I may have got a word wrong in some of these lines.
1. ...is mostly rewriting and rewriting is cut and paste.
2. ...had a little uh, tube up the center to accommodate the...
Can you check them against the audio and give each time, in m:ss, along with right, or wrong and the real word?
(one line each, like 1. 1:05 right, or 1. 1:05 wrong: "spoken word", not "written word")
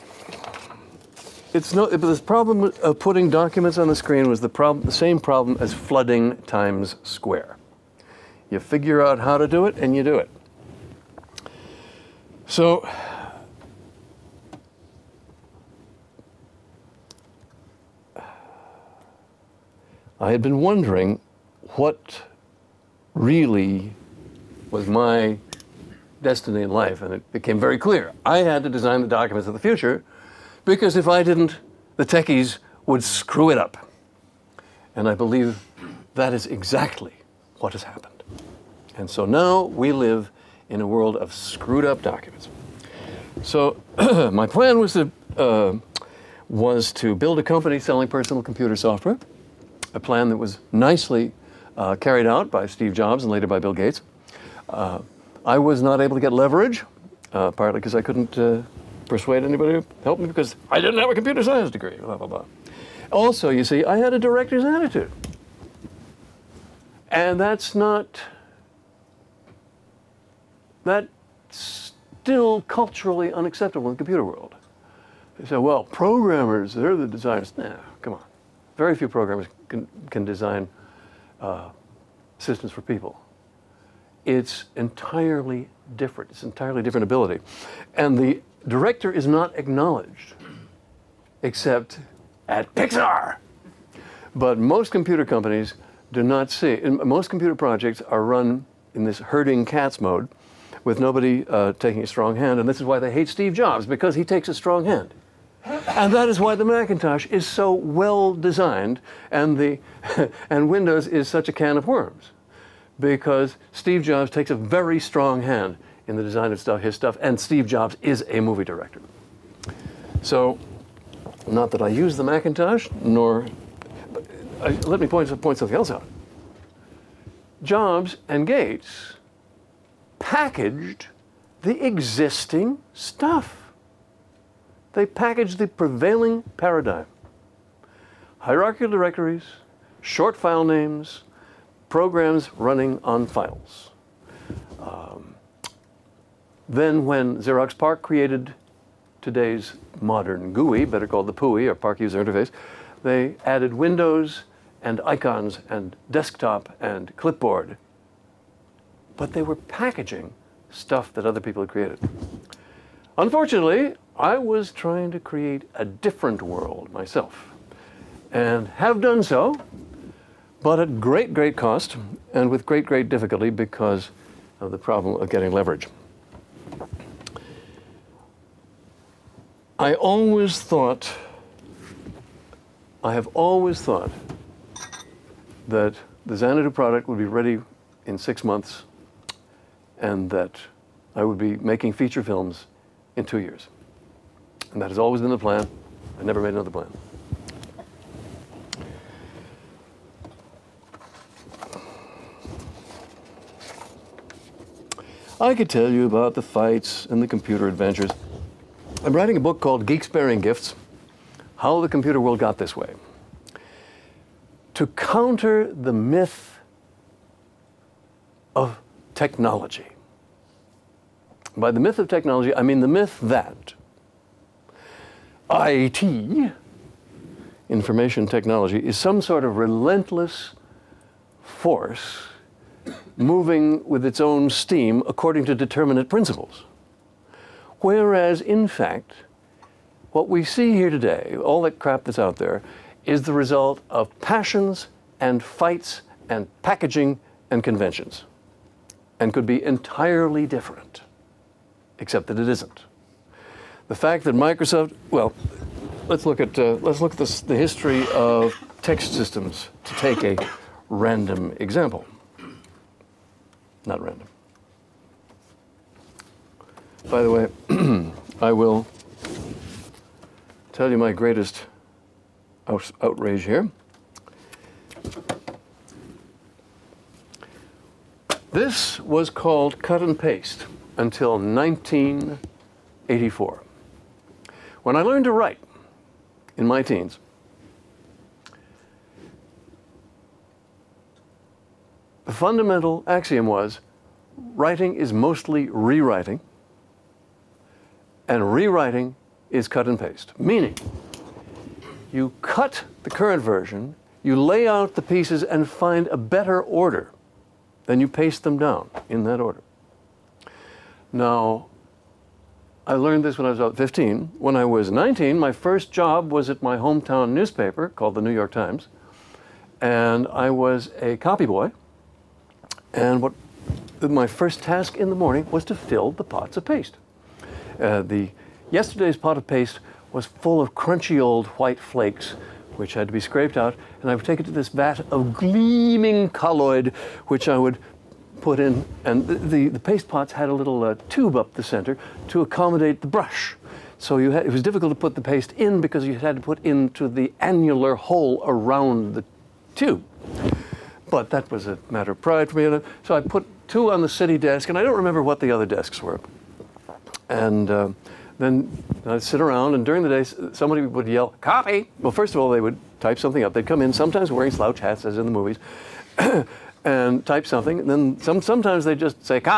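1. 4:54 right
2. 5:40 right.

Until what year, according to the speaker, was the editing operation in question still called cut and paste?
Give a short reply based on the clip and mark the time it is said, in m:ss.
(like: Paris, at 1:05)
1984, at 4:41.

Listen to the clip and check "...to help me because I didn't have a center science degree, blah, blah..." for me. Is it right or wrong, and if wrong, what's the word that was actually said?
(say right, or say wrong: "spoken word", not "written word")
wrong: "computer", not "center".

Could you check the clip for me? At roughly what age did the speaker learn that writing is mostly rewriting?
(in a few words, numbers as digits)
15.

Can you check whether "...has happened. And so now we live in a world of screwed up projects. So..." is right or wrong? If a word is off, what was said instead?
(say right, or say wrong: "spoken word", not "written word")
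wrong: "documents", not "projects".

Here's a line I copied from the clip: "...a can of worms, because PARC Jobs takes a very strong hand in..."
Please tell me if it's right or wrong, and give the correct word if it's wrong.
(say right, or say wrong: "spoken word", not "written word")
wrong: "Steve", not "PARC".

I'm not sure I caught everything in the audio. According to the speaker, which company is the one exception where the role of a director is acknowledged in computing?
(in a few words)
Pixar.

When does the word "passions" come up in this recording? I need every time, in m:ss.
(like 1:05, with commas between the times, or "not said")
4:04.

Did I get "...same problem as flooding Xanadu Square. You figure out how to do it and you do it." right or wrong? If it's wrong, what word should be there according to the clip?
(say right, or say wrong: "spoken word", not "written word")
wrong: "Times", not "Xanadu".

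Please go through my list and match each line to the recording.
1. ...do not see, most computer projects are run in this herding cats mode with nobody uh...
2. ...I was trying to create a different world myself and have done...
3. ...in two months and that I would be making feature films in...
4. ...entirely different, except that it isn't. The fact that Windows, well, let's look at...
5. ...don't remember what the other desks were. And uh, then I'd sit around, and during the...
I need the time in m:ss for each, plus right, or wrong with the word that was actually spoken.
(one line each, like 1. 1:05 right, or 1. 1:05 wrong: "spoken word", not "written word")
1. 1:36 right
2. 2:44 right
3. 3:08 wrong: "six", not "two"
4. 4:09 wrong: "Microsoft", not "Windows"
5. 5:54 right.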